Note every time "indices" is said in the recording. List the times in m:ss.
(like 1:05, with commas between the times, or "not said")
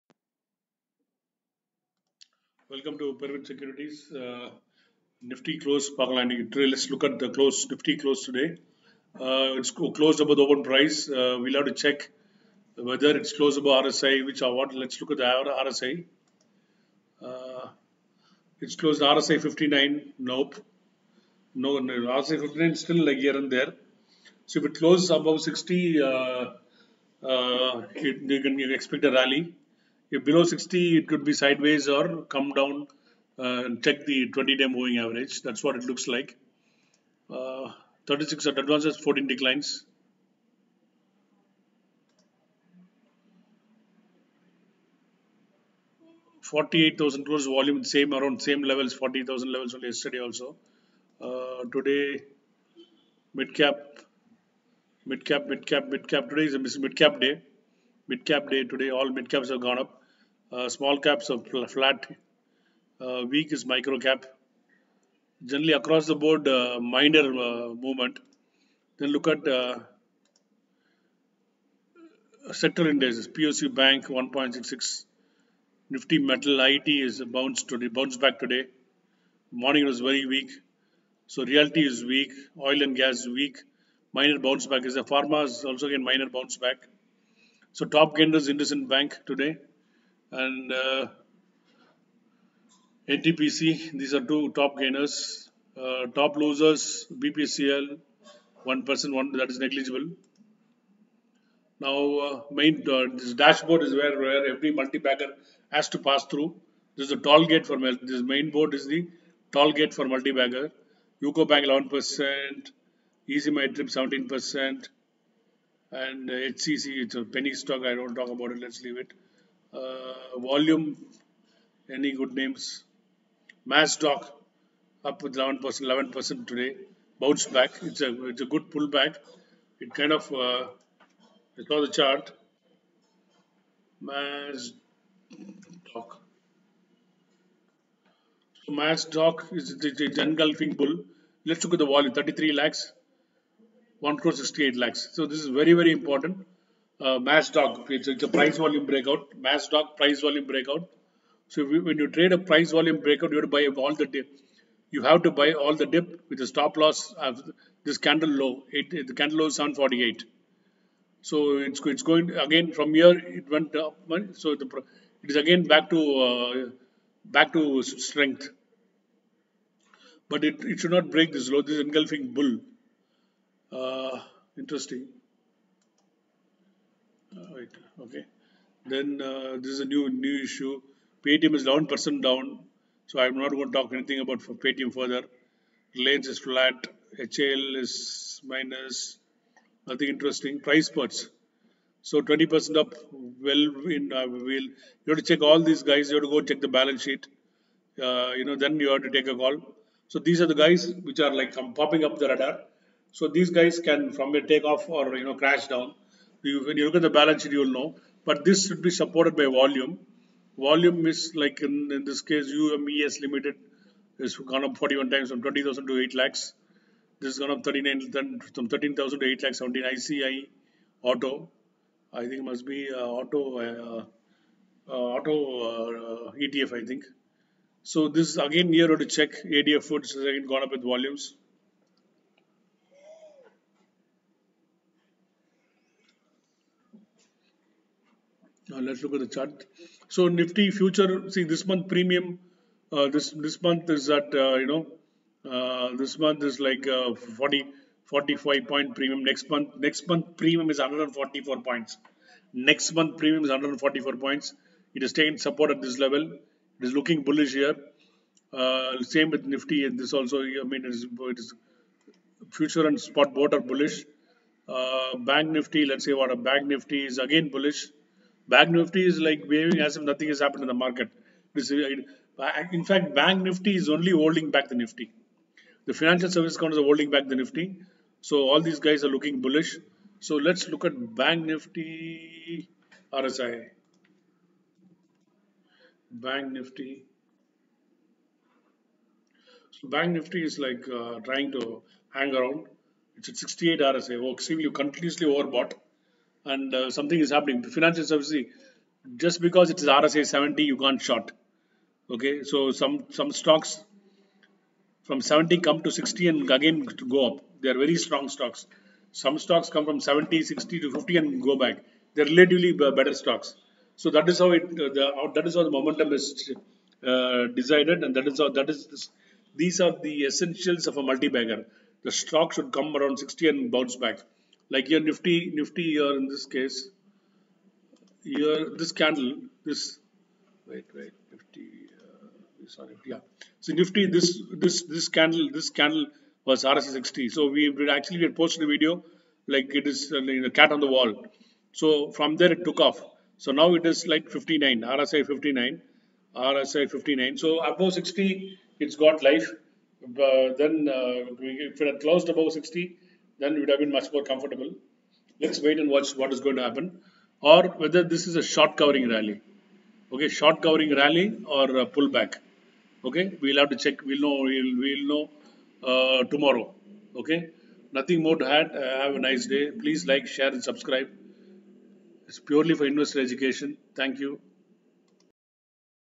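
1:12.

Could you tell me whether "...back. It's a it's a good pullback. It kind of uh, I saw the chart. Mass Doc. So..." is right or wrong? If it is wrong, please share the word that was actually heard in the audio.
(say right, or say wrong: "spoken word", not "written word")
right.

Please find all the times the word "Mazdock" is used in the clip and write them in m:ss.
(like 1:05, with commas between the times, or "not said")
2:03, 2:18, 2:29.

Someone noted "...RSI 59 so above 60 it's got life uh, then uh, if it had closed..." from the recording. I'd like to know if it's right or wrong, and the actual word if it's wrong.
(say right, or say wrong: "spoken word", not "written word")
right.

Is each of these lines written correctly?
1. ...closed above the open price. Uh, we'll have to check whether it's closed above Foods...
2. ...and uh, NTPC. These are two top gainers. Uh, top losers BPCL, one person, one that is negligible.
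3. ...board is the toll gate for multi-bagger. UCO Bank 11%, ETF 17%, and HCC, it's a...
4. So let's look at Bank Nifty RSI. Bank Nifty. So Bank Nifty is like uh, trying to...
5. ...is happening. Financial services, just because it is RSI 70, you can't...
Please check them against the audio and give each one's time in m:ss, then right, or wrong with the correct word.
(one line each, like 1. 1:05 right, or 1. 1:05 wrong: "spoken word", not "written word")
1. 0:09 wrong: "RSI", not "Foods"
2. 1:30 right
3. 1:48 wrong: "EaseMyTrip", not "ETF"
4. 4:40 right
5. 4:57 right.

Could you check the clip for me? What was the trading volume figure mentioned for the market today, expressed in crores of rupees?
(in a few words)
48,000 crores.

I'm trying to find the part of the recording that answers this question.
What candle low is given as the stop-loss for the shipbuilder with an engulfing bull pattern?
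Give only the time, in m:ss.
2:39.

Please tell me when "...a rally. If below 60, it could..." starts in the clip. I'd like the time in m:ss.
0:29.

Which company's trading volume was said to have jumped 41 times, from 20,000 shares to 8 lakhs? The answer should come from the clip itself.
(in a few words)
UMES Limited.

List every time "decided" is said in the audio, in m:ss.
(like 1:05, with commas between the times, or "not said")
5:17.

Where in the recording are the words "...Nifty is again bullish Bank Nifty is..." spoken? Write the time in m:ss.
4:26.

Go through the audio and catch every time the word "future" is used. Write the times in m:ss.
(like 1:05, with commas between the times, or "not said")
4:00, 4:22.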